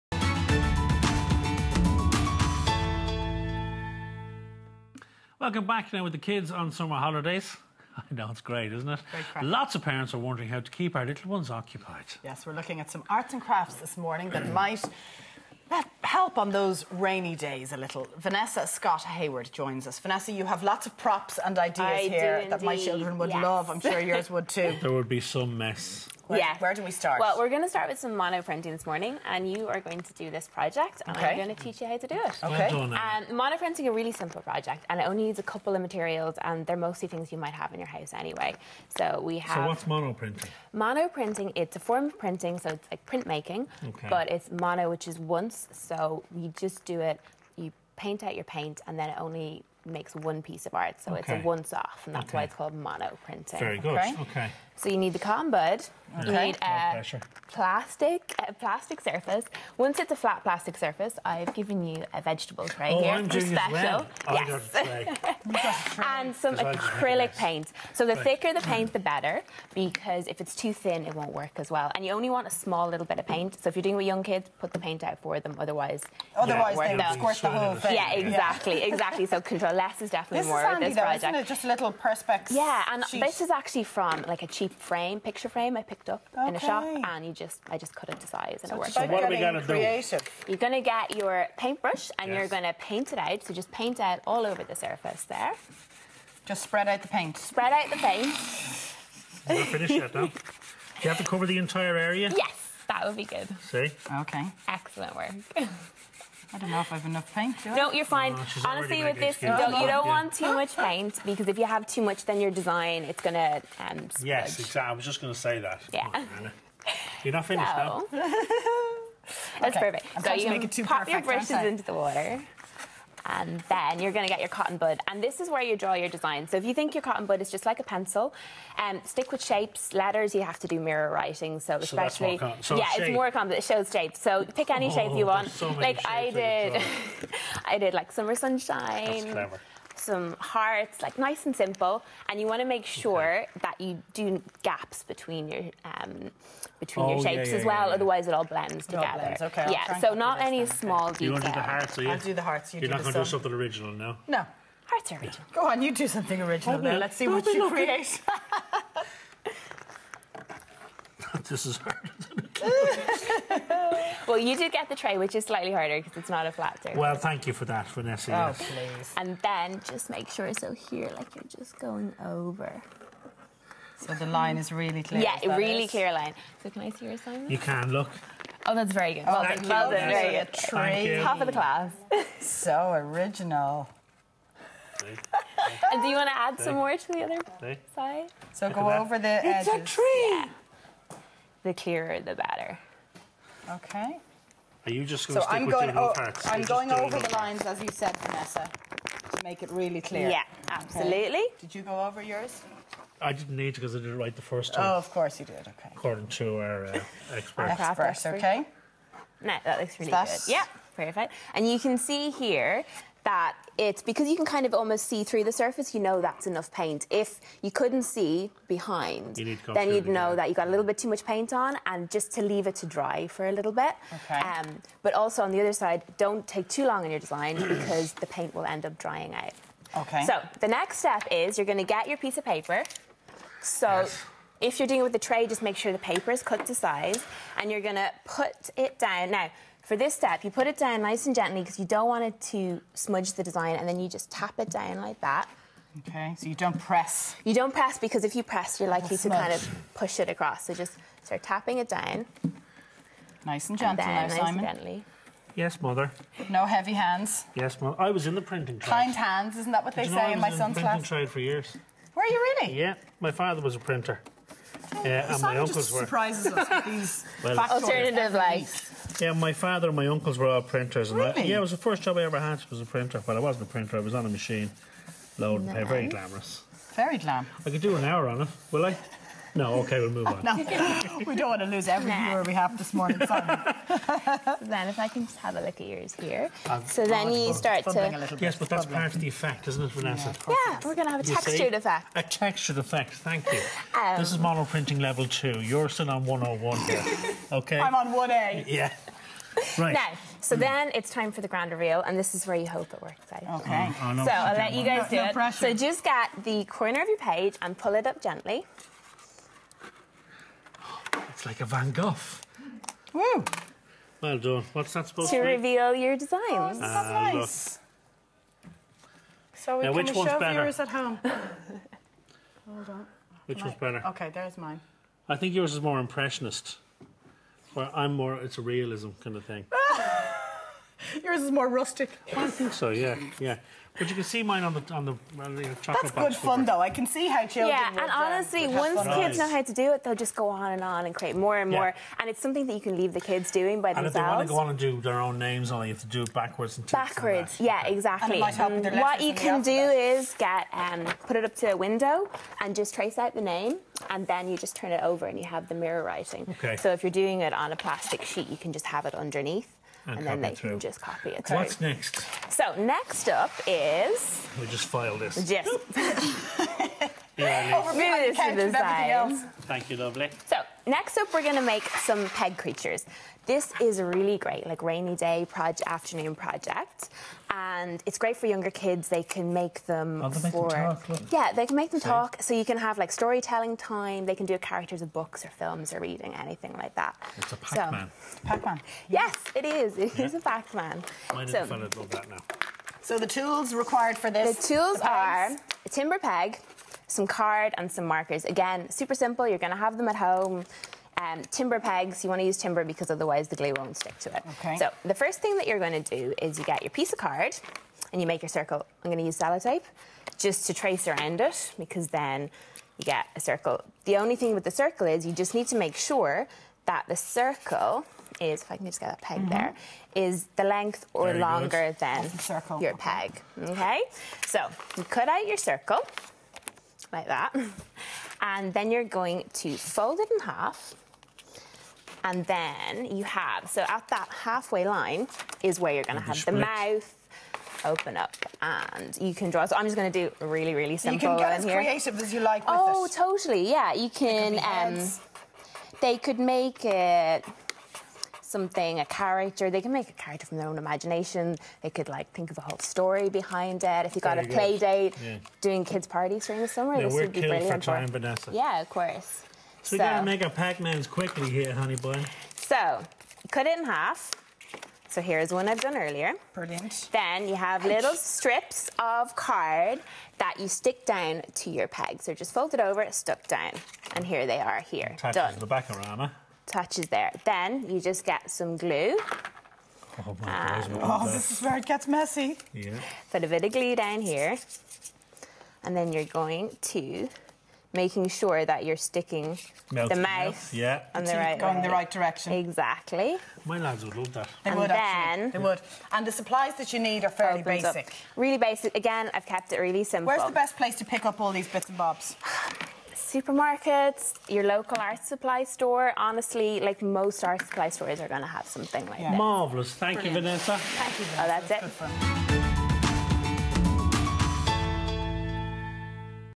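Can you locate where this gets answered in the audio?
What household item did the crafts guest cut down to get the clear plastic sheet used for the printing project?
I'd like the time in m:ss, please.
1:25.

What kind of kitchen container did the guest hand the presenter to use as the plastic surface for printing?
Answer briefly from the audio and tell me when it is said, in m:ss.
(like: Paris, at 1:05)
vegetable tray, at 1:02.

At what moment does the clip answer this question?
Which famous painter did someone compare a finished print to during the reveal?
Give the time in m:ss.
5:11.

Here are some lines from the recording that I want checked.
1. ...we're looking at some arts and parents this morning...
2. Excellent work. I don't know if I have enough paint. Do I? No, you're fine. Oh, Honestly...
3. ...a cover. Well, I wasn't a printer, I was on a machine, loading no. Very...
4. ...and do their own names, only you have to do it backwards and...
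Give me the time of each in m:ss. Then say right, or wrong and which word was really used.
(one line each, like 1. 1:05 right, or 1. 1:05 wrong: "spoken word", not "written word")
1. 0:12 wrong: "crafts", not "parents"
2. 1:44 right
3. 4:32 wrong: "printer", not "cover"
4. 5:44 right.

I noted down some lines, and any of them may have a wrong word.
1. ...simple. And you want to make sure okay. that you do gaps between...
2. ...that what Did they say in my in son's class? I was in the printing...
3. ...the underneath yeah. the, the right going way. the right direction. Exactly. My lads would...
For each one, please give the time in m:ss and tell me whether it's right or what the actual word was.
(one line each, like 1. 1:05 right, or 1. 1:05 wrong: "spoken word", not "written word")
1. 2:21 right
2. 4:19 right
3. 8:10 wrong: "mouth", not "underneath".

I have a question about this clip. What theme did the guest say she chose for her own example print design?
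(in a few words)
summer sunshine.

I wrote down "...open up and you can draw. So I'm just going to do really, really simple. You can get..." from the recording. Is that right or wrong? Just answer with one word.
right.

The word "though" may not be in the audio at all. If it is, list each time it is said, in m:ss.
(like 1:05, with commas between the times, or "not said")
1:40, 1:57, 5:36.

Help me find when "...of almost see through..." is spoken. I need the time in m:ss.
3:34.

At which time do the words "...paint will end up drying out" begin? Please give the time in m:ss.
3:48.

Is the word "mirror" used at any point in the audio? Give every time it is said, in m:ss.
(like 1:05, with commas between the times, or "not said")
2:10, 5:55.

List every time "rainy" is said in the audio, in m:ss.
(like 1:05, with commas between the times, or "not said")
0:16, 6:14.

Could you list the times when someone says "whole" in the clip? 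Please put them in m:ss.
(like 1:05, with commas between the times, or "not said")
1:17, 7:32.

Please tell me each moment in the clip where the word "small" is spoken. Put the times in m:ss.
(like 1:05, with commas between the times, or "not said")
1:12, 2:30.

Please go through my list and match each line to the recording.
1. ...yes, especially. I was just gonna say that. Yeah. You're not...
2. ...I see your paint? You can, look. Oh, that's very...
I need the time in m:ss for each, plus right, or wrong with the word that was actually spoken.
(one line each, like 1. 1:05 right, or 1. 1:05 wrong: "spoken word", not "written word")
1. 1:54 wrong: "exactly", not "especially"
2. 2:56 wrong: "assignment", not "paint".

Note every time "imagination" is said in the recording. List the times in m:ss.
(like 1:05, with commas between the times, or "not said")
7:30.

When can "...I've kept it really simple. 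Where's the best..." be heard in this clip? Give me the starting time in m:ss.
8:19.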